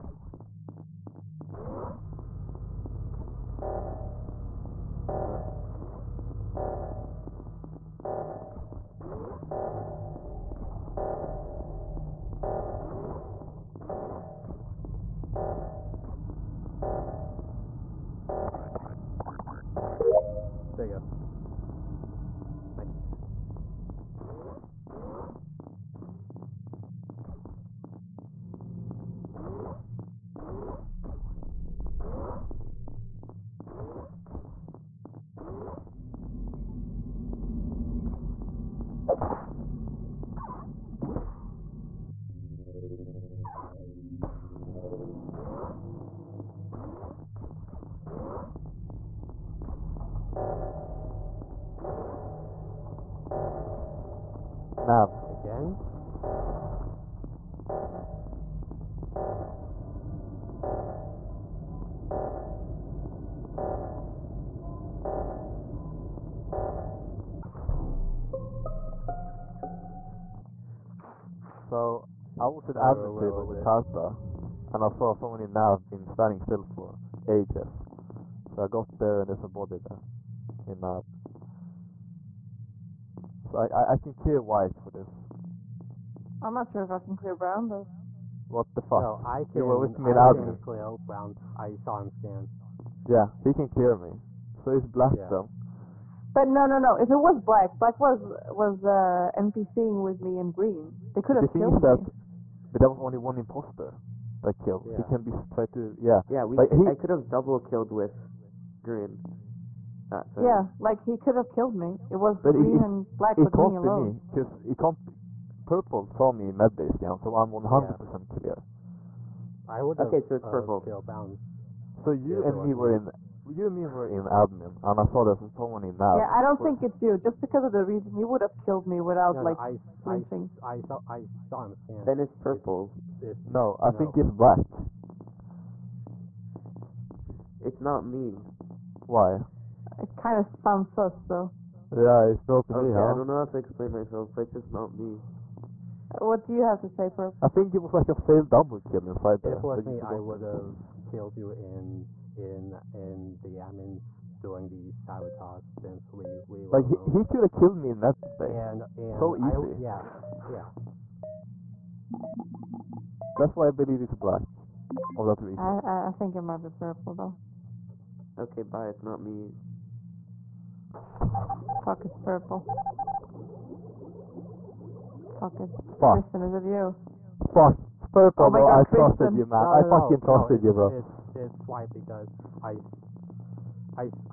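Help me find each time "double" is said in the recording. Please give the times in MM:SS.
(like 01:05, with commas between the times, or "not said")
01:47, 02:28.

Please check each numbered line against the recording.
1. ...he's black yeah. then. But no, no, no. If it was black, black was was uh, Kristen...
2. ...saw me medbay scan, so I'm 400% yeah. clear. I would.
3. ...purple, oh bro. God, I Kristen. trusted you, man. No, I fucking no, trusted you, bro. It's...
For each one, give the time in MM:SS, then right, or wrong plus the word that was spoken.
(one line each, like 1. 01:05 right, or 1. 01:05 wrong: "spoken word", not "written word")
1. 01:34 wrong: "NPCing", not "Kristen"
2. 01:56 wrong: "100", not "400"
3. 02:58 right.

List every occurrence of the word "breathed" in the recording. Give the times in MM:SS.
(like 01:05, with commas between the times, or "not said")
not said.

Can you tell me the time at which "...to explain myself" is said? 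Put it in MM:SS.
02:23.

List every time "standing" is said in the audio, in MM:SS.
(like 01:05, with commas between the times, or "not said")
01:16.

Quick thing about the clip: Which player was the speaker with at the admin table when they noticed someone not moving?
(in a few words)
Karta.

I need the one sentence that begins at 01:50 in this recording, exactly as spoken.
Uh, yeah, like he could have killed me.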